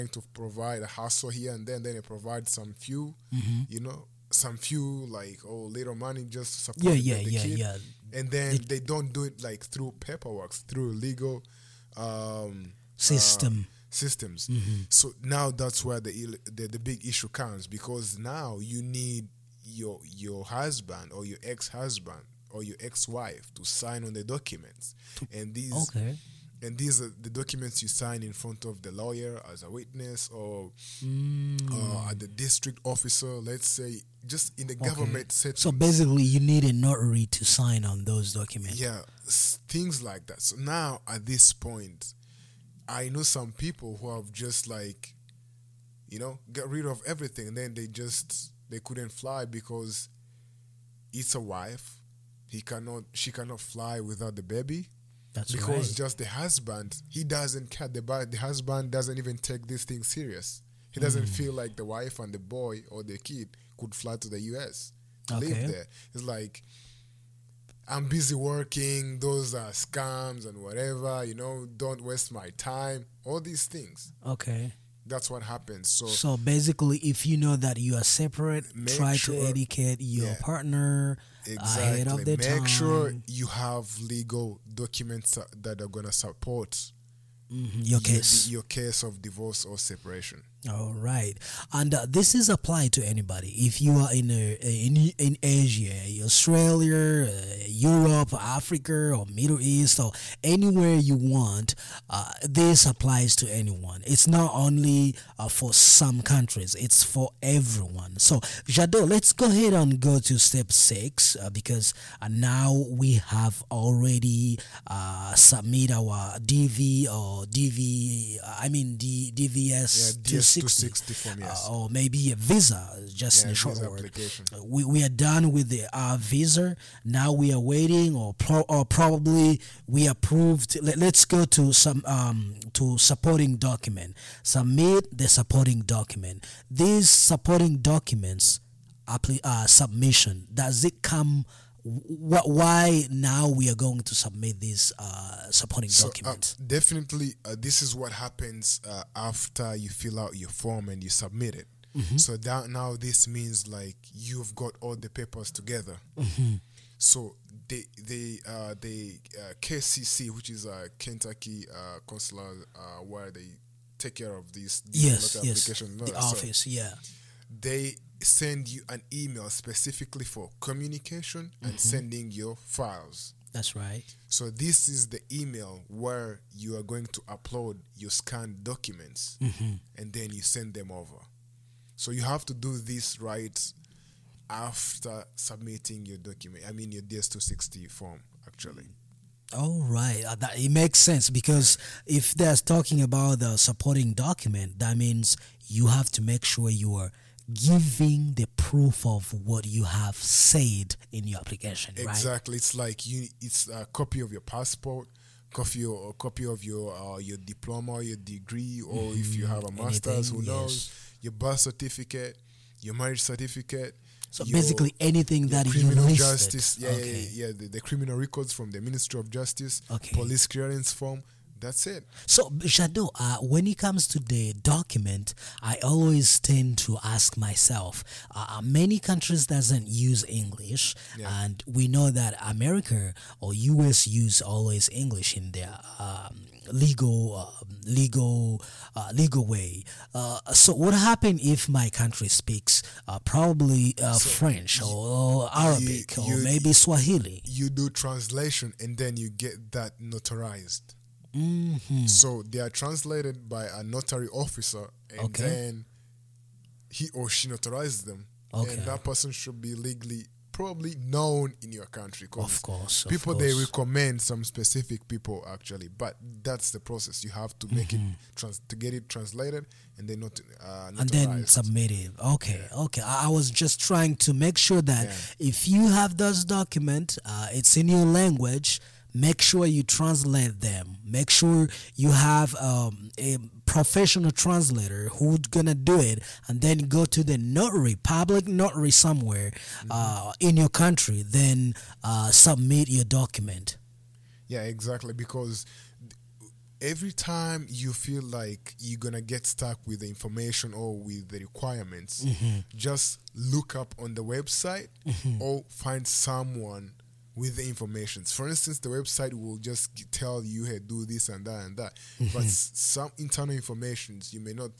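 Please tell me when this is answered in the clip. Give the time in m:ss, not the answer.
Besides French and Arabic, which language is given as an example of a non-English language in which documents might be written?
4:06.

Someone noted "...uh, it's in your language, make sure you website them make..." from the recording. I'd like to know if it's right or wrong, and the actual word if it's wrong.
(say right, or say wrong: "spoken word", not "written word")
wrong: "translate", not "website".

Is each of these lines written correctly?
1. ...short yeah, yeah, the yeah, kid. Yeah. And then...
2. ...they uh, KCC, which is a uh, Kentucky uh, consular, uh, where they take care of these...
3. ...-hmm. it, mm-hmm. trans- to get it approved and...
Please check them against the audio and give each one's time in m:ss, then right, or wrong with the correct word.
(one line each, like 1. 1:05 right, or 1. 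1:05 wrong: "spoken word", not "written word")
1. 0:06 wrong: "support", not "short"
2. 2:38 right
3. 4:27 wrong: "translated", not "approved".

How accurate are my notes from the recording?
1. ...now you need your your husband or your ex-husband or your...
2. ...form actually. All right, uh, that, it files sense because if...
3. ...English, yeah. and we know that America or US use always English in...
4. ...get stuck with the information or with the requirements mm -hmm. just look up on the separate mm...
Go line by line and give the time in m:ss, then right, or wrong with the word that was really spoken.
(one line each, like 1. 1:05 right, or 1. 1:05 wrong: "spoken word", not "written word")
1. 0:18 right
2. 3:07 wrong: "makes", not "files"
3. 3:50 right
4. 4:59 wrong: "website", not "separate".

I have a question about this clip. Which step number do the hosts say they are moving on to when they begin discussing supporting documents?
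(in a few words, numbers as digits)
6.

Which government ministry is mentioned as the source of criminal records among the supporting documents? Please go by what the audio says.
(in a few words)
Ministry of Justice.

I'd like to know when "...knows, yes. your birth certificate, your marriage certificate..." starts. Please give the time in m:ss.
3:30.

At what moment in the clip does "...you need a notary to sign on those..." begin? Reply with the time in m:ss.
0:36.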